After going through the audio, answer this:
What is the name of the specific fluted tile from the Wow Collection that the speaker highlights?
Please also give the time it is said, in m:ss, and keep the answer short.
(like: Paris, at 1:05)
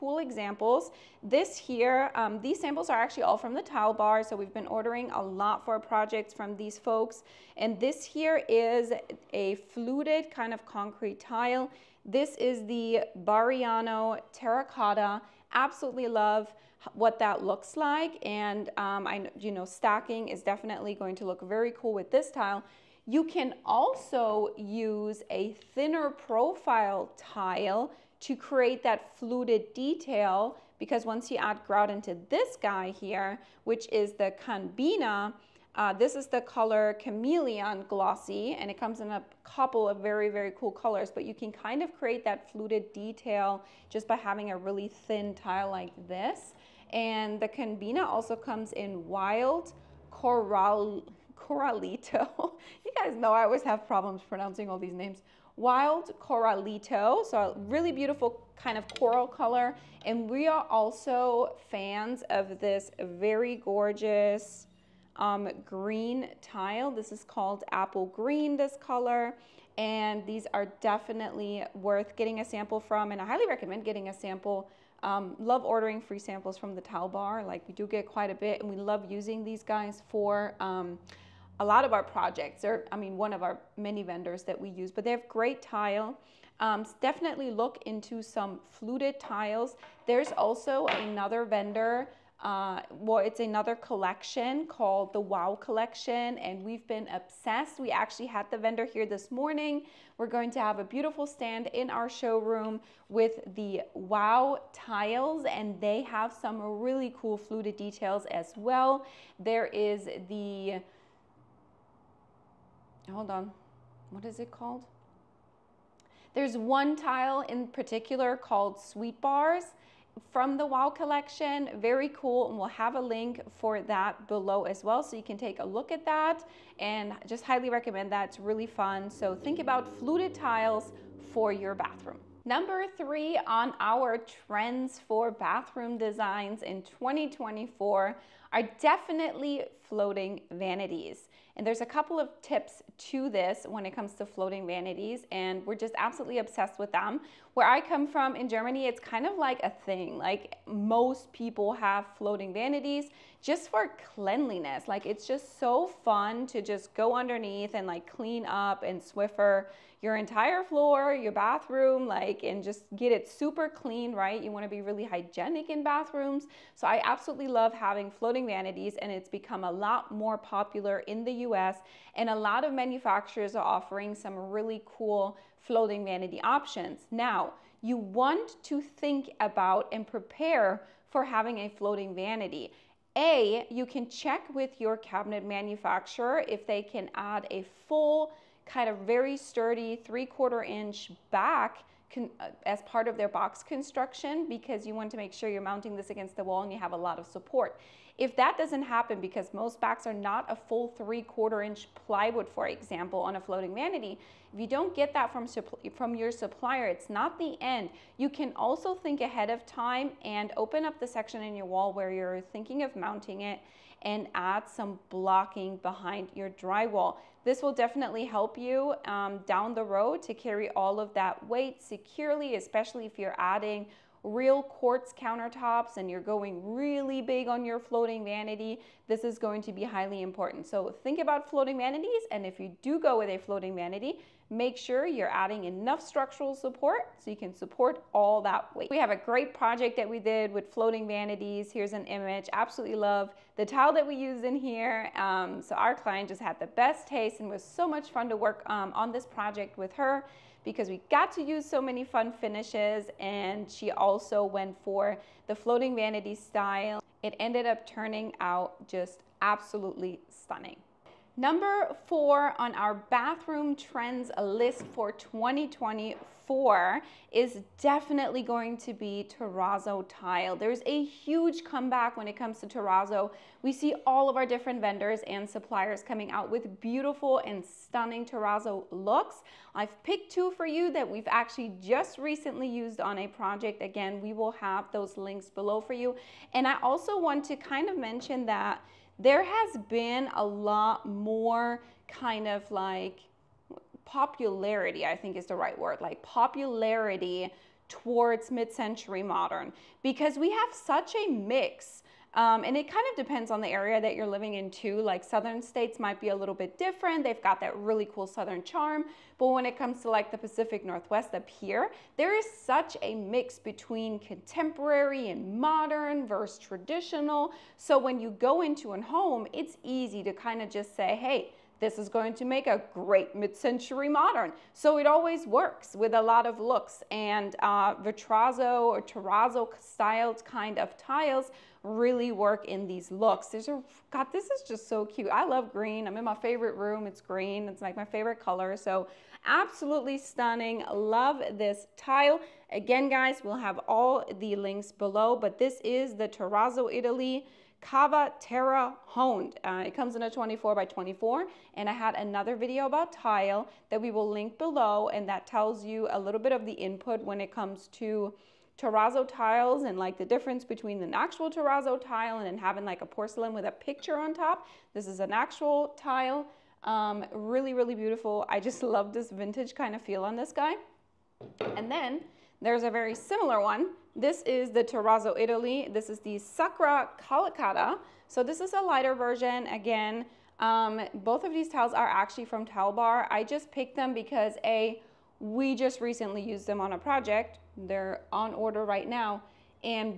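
Sweet Bars, at 1:58.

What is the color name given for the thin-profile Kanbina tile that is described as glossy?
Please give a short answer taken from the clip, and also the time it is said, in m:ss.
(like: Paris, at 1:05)
Chameleon, at 0:36.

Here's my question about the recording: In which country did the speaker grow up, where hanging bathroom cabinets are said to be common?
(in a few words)
Germany.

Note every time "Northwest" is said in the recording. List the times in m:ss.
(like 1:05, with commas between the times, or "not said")
5:10.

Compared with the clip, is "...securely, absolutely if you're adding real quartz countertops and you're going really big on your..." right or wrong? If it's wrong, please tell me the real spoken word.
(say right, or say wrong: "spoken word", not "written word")
wrong: "especially", not "absolutely".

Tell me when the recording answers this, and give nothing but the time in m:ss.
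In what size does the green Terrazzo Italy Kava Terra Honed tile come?
5:50.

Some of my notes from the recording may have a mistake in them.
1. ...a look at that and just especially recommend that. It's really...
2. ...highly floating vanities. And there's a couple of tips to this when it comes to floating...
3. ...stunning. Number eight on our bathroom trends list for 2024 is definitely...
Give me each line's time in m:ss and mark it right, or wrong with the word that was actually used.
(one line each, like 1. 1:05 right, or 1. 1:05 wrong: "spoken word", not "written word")
1. 2:05 wrong: "highly", not "especially"
2. 2:18 wrong: "definitely", not "highly"
3. 4:20 wrong: "four", not "eight".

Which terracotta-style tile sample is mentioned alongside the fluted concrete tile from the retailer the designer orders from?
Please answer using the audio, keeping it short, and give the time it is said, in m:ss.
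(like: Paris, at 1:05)
Bariano, at 0:13.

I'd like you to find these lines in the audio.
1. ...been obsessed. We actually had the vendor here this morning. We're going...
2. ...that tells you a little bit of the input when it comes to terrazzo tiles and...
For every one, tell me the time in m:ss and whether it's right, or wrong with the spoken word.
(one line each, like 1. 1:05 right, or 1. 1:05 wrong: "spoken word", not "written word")
1. 1:36 right
2. 5:55 right.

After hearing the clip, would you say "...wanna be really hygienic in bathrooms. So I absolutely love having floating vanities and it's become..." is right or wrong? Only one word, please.
right.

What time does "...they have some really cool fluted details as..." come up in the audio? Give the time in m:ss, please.
1:45.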